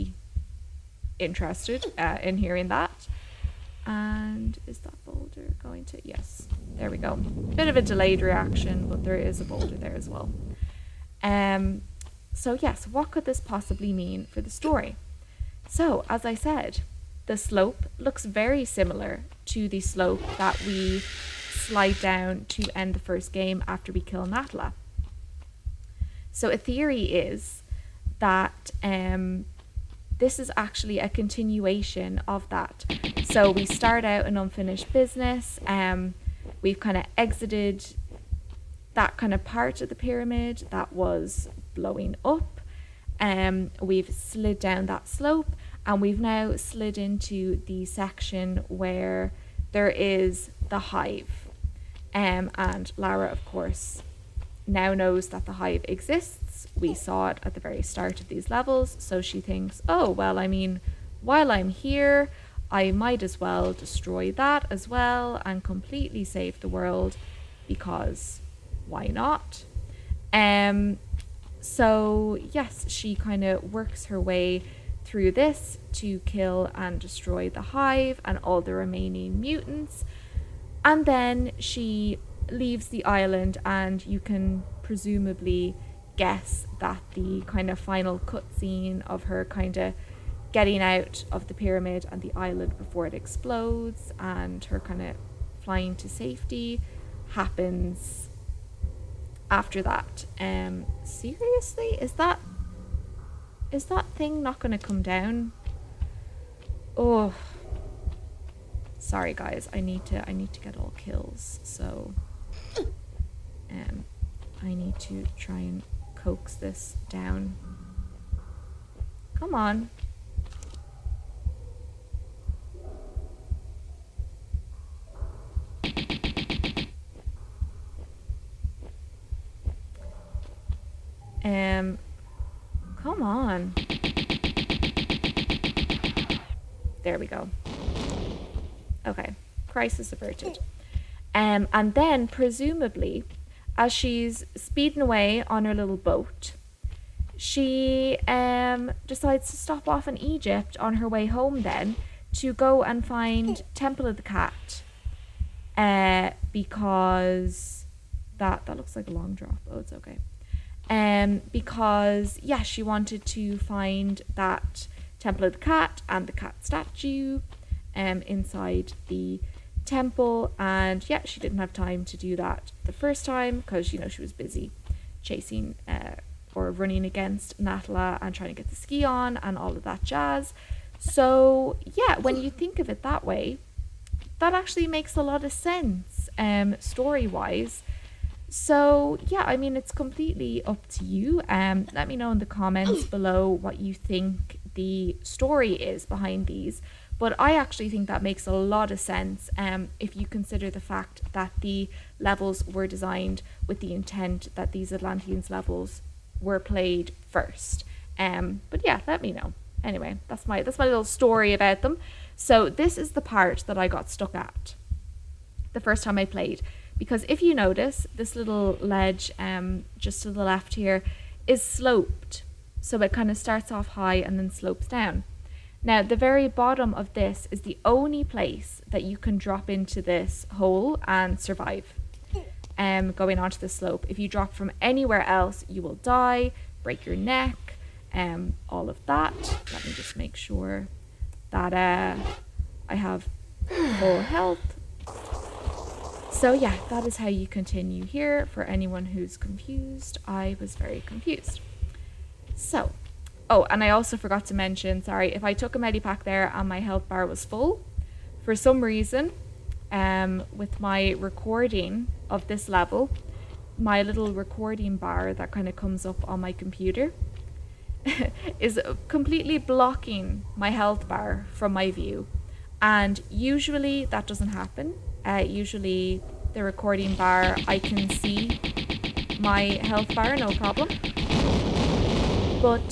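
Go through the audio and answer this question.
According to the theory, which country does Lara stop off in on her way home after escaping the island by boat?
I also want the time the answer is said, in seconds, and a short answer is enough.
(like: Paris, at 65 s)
Egypt, at 150 s.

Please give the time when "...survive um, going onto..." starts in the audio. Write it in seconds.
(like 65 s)
231 s.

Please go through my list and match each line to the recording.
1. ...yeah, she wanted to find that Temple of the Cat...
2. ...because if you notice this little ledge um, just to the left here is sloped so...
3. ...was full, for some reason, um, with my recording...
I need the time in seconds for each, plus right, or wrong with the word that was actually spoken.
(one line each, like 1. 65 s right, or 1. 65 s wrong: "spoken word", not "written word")
1. 162 s right
2. 216 s right
3. 257 s right.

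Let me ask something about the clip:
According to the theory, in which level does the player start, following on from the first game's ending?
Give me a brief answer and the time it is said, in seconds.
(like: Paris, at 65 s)
Unfinished Business, at 34 s.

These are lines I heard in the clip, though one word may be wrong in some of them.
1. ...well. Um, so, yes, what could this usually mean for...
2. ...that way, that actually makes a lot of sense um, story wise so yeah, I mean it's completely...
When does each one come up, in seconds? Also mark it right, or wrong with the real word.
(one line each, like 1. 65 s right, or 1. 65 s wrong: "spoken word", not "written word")
1. 10 s wrong: "possibly", not "usually"
2. 183 s right.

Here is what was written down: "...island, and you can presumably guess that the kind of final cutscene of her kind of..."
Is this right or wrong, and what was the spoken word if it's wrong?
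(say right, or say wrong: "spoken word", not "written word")
right.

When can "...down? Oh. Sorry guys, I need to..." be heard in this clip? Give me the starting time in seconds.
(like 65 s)
105 s.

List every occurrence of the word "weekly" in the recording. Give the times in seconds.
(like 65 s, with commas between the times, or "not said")
not said.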